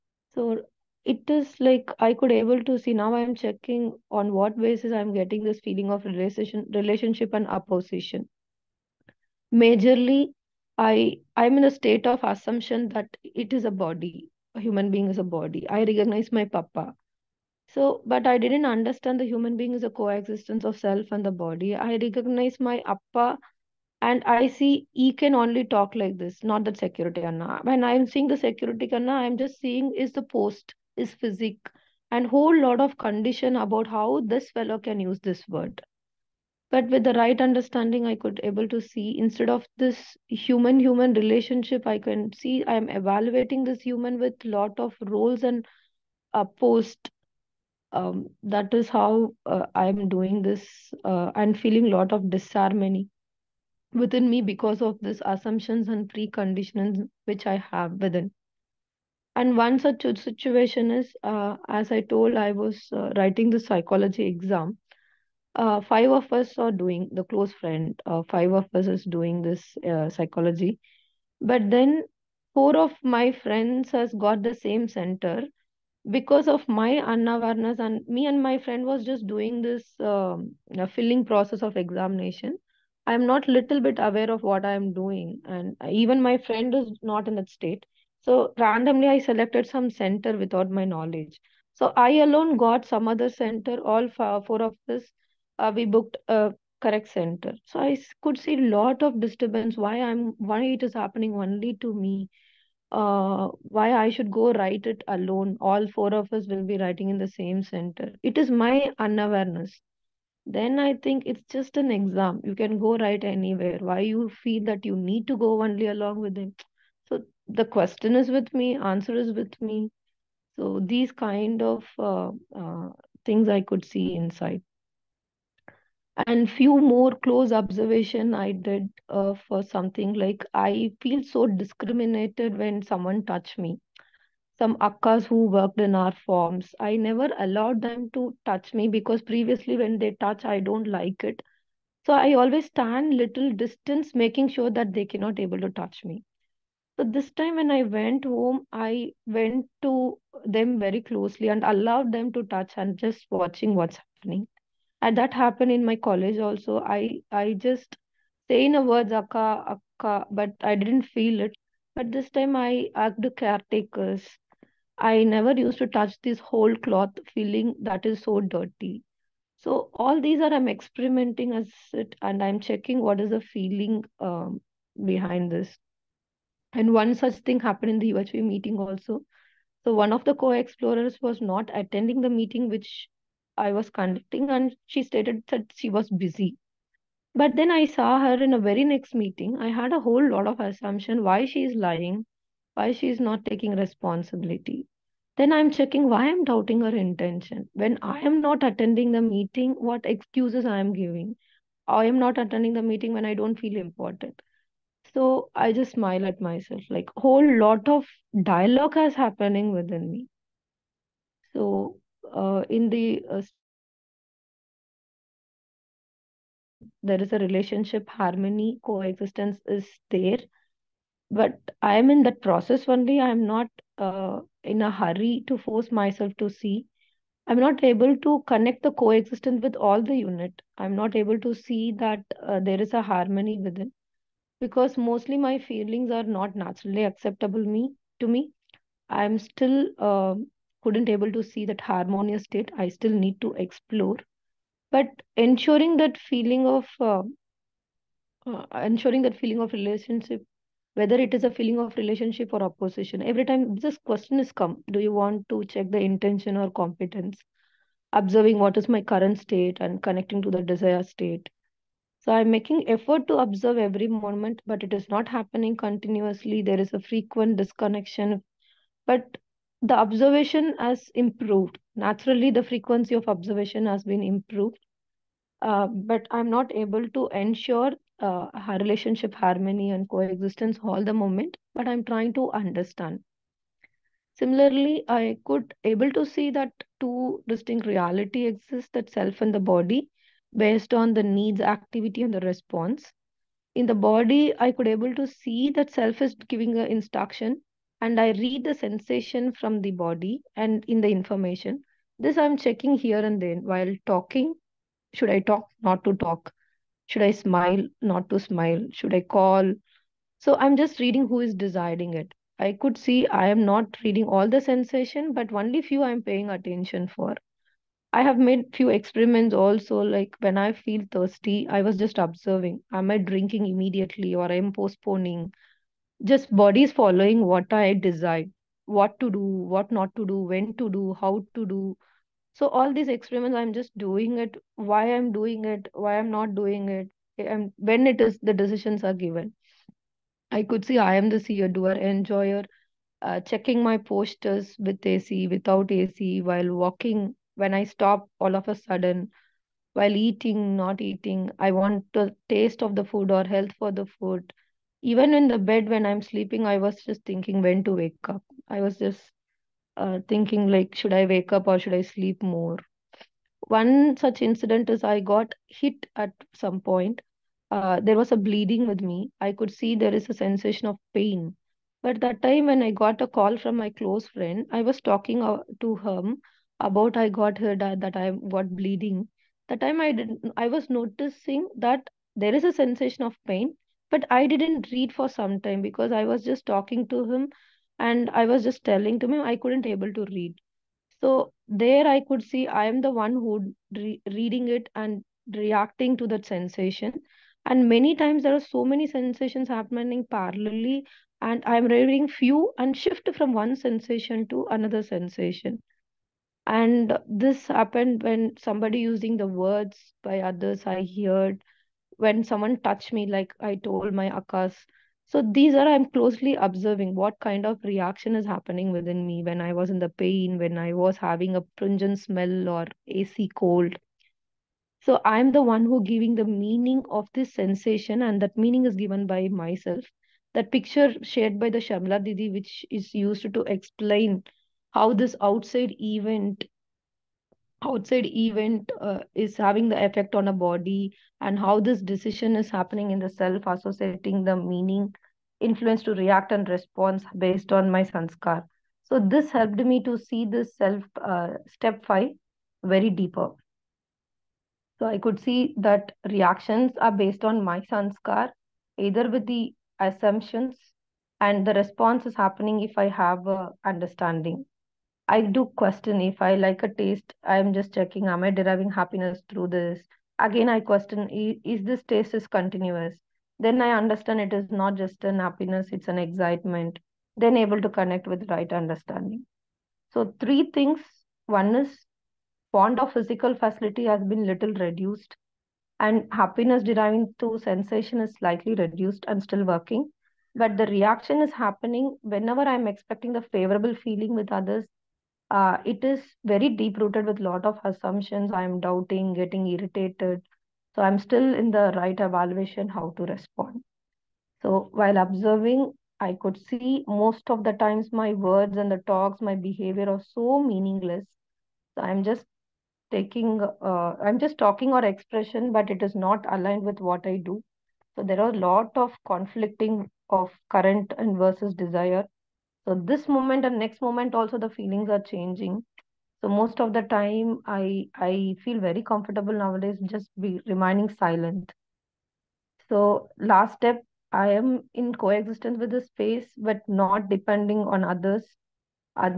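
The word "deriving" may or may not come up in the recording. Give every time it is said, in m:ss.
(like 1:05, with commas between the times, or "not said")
7:48, 8:06.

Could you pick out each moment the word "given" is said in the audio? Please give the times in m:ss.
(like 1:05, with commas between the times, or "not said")
5:39, 7:08.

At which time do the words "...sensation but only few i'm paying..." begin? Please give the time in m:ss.
5:14.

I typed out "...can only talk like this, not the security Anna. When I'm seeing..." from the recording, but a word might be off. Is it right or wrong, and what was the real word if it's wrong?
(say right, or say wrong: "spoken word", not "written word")
right.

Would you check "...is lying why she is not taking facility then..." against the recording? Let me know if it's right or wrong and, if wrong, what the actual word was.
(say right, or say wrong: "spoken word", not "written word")
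wrong: "responsibility", not "facility".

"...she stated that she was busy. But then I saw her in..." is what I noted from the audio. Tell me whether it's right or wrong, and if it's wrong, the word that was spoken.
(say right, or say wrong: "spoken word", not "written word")
right.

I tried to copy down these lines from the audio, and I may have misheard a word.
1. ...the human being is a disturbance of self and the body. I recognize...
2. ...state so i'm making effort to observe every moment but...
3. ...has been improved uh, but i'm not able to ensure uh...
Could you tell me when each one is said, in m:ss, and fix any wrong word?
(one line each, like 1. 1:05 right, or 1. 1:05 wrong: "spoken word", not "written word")
1. 0:19 wrong: "coexistence", not "disturbance"
2. 4:21 right
3. 4:33 right.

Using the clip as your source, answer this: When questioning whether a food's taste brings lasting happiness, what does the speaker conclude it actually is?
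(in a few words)
Excitement.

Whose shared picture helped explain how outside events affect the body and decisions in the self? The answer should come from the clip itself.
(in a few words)
Shamla Didi.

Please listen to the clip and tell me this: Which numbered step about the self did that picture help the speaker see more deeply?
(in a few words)
Step 5.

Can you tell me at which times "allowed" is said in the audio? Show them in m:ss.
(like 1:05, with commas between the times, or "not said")
2:17, 2:31.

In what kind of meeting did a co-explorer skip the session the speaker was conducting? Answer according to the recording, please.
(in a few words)
UHV meeting.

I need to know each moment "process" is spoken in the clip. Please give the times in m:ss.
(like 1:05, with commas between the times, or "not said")
1:21, 3:42.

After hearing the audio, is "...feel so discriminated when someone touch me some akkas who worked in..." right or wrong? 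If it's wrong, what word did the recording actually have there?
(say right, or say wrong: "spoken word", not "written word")
right.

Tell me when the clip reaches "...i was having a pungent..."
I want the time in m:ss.
7:00.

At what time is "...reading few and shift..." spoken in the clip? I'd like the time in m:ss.
6:41.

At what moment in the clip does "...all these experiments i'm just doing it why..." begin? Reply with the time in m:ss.
5:32.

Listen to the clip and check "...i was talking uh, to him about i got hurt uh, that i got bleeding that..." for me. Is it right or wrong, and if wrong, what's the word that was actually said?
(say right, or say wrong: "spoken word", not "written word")
right.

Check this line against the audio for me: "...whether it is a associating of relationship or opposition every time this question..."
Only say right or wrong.
wrong.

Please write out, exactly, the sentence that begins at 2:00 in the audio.
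So these kind of uh, uh, things I could see inside.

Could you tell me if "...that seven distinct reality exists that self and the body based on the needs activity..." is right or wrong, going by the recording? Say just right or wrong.
wrong.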